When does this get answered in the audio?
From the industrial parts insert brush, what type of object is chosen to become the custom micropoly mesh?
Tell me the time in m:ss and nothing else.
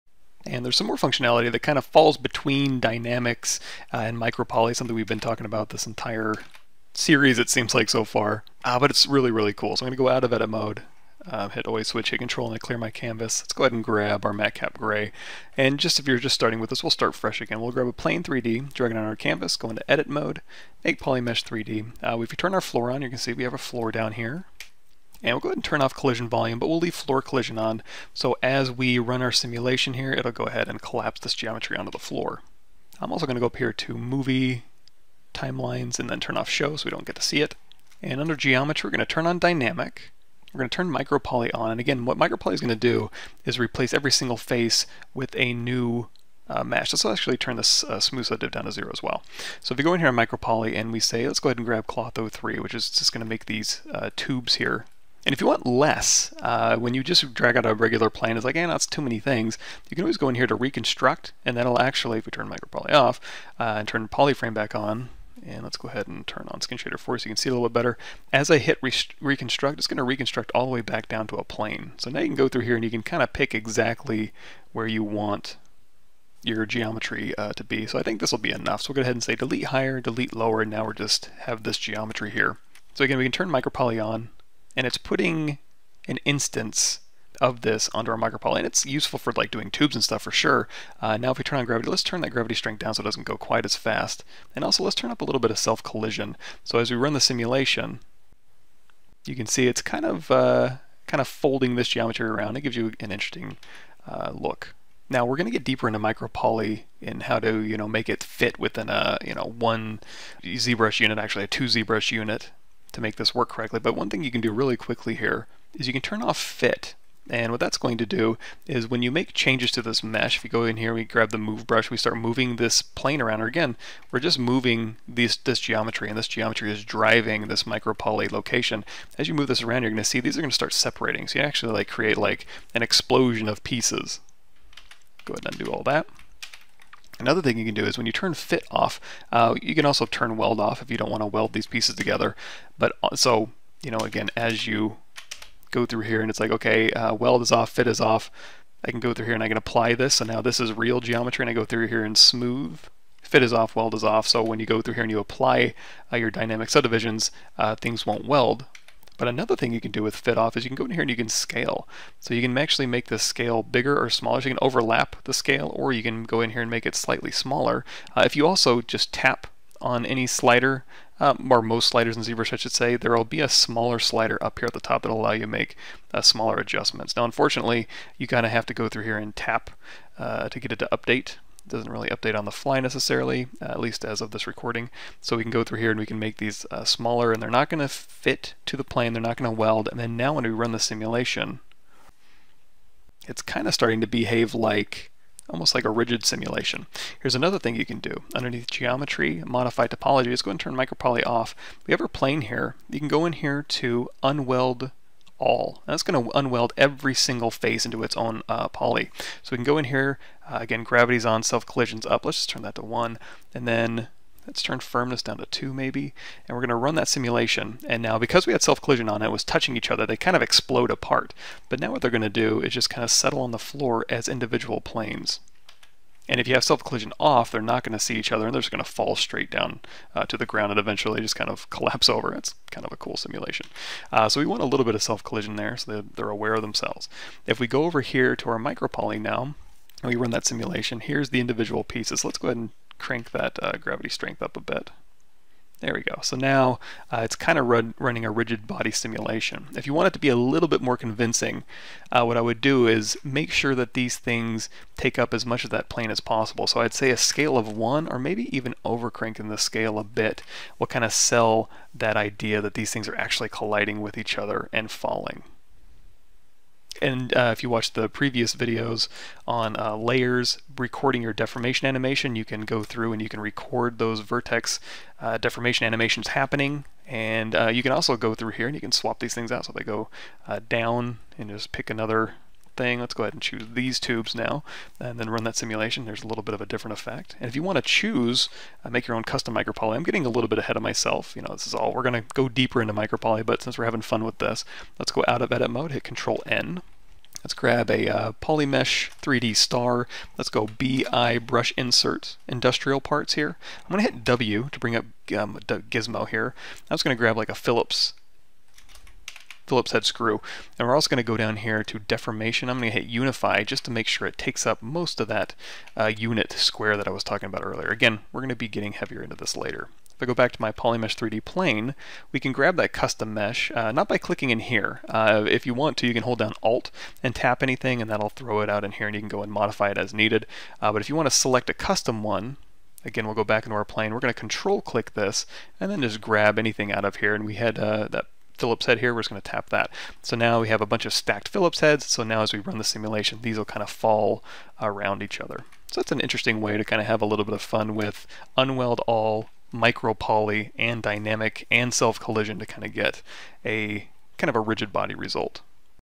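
5:09.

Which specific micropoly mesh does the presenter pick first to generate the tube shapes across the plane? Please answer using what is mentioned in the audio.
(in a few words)
Cloth 03.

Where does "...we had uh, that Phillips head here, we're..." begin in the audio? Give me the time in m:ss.
5:37.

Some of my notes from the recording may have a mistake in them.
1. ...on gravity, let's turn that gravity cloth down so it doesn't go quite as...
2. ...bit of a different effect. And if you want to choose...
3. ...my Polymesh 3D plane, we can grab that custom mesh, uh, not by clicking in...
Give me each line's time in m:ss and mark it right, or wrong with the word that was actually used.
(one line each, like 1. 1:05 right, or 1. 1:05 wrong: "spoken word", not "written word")
1. 1:31 wrong: "strength", not "cloth"
2. 4:46 right
3. 5:20 right.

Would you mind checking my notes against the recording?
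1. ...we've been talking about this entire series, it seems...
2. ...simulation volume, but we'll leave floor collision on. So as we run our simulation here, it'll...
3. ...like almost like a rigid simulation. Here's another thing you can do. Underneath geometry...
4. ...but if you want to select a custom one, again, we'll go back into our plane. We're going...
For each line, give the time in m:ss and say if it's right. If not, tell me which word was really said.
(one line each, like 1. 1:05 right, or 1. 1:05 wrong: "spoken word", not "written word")
1. 0:04 right
2. 0:25 wrong: "collision", not "simulation"
3. 3:14 right
4. 5:30 right.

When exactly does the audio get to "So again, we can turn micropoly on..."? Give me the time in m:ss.
1:22.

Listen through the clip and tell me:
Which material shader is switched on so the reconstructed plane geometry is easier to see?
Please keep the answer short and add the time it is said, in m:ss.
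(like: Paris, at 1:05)
Skin shader 4, at 1:06.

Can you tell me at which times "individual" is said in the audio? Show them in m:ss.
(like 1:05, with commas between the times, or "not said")
3:44, 4:01.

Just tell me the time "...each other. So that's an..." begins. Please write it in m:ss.
5:45.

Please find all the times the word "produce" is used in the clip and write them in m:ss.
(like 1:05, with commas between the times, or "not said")
not said.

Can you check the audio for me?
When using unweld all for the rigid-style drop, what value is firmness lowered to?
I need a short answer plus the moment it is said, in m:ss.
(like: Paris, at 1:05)
2, at 3:34.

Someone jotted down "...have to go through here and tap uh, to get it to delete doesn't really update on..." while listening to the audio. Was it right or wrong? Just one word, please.
wrong.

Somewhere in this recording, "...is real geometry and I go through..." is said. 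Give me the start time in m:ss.
2:30.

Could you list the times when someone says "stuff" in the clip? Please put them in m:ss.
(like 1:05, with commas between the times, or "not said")
1:30.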